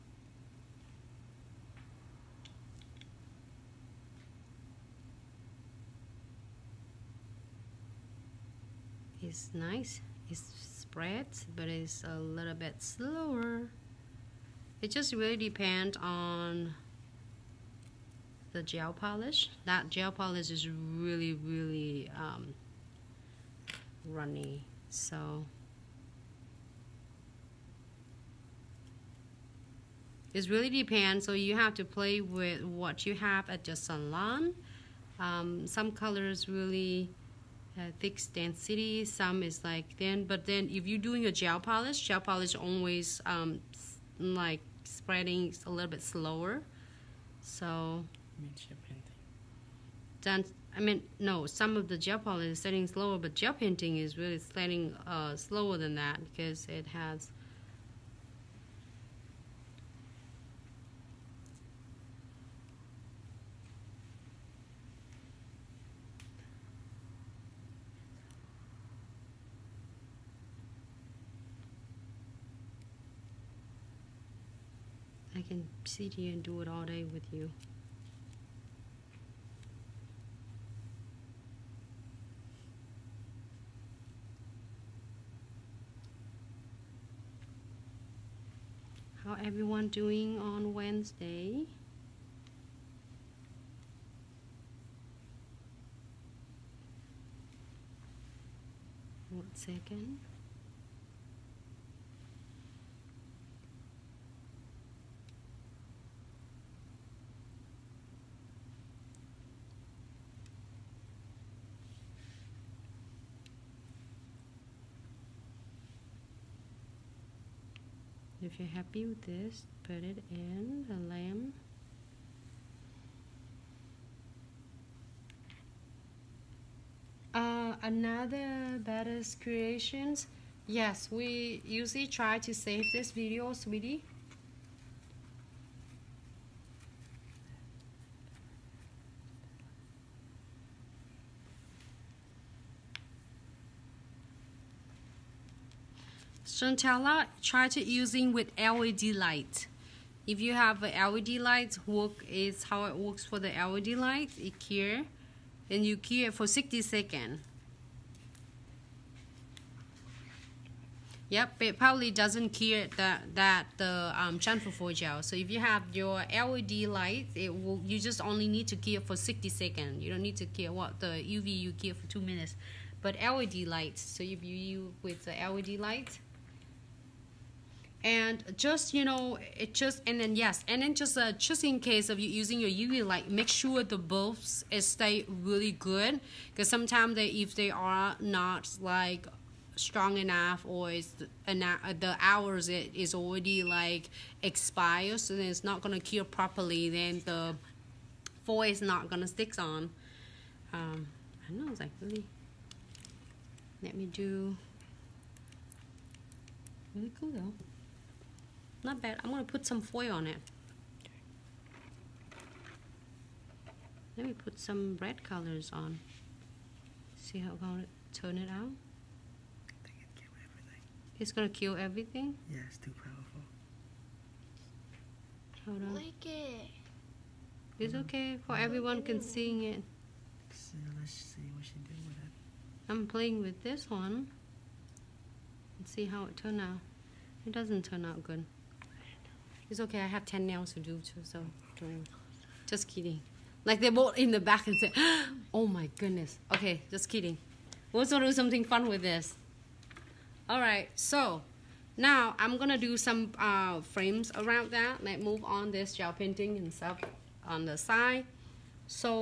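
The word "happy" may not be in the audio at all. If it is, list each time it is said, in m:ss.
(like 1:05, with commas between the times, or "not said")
1:58.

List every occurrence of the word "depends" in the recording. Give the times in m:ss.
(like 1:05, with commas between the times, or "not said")
0:15, 0:30.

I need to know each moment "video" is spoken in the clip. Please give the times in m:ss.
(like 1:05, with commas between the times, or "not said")
2:13.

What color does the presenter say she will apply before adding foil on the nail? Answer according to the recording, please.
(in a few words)
red.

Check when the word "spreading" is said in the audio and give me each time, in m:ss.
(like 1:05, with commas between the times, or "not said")
0:44.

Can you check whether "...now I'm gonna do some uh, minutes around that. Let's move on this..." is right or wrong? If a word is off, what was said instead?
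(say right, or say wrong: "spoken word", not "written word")
wrong: "frames", not "minutes".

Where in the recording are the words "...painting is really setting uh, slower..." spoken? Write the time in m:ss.
0:53.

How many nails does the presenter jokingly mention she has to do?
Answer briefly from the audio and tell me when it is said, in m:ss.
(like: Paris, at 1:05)
10, at 4:00.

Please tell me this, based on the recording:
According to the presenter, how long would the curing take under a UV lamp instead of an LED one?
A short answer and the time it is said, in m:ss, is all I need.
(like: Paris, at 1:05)
two minutes, at 2:52.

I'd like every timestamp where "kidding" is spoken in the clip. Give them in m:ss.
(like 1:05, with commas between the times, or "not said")
4:02, 4:07.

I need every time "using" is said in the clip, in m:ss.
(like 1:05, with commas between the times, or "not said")
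2:27, 3:02.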